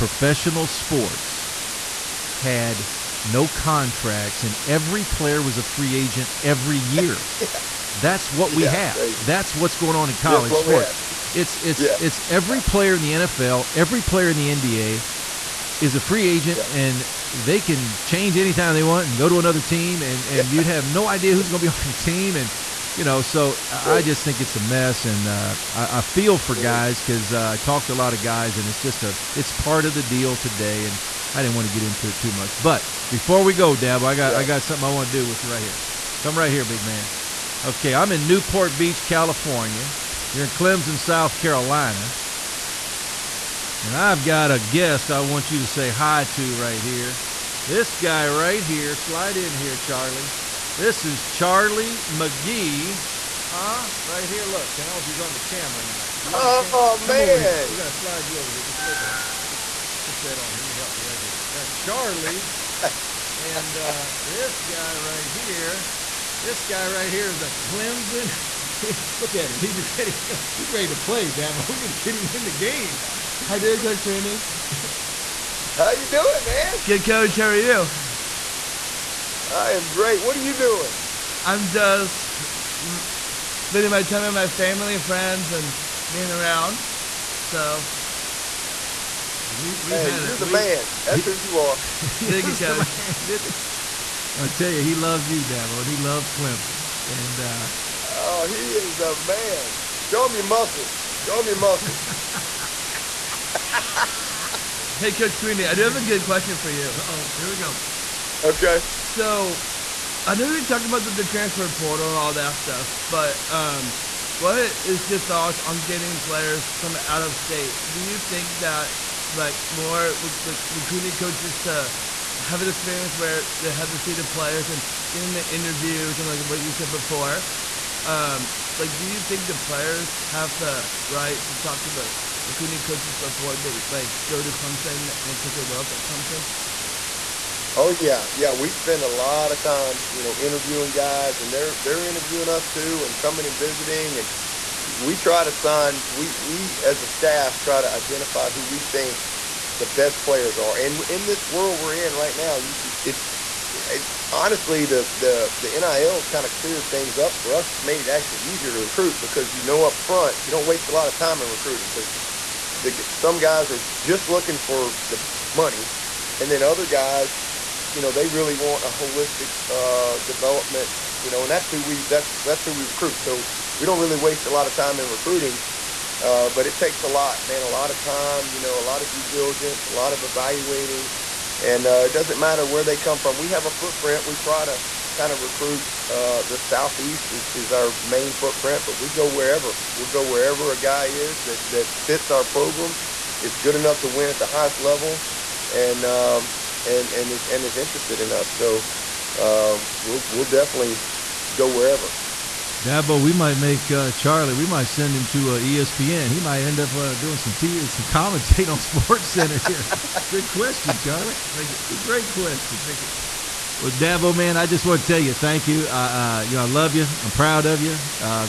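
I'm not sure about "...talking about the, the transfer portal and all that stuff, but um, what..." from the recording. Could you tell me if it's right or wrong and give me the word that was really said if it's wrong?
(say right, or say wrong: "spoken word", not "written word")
right.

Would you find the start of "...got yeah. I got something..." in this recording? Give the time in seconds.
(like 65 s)
34 s.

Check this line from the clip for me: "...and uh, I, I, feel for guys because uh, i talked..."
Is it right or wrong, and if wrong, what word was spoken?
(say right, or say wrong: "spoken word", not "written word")
right.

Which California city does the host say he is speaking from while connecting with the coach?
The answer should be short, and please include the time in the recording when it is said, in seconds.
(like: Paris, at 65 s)
Newport Beach, at 38 s.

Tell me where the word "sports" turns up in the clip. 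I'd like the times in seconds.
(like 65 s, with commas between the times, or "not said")
0 s, 10 s, 208 s.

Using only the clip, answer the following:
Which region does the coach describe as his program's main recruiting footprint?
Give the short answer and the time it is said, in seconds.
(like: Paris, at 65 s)
the southeast, at 186 s.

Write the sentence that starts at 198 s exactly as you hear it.
So uh, we'll we'll definitely go wherever.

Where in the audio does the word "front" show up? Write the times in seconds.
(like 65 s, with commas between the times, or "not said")
159 s.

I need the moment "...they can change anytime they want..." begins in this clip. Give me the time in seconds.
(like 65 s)
17 s.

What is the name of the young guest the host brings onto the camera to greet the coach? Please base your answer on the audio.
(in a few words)
Charlie McGee.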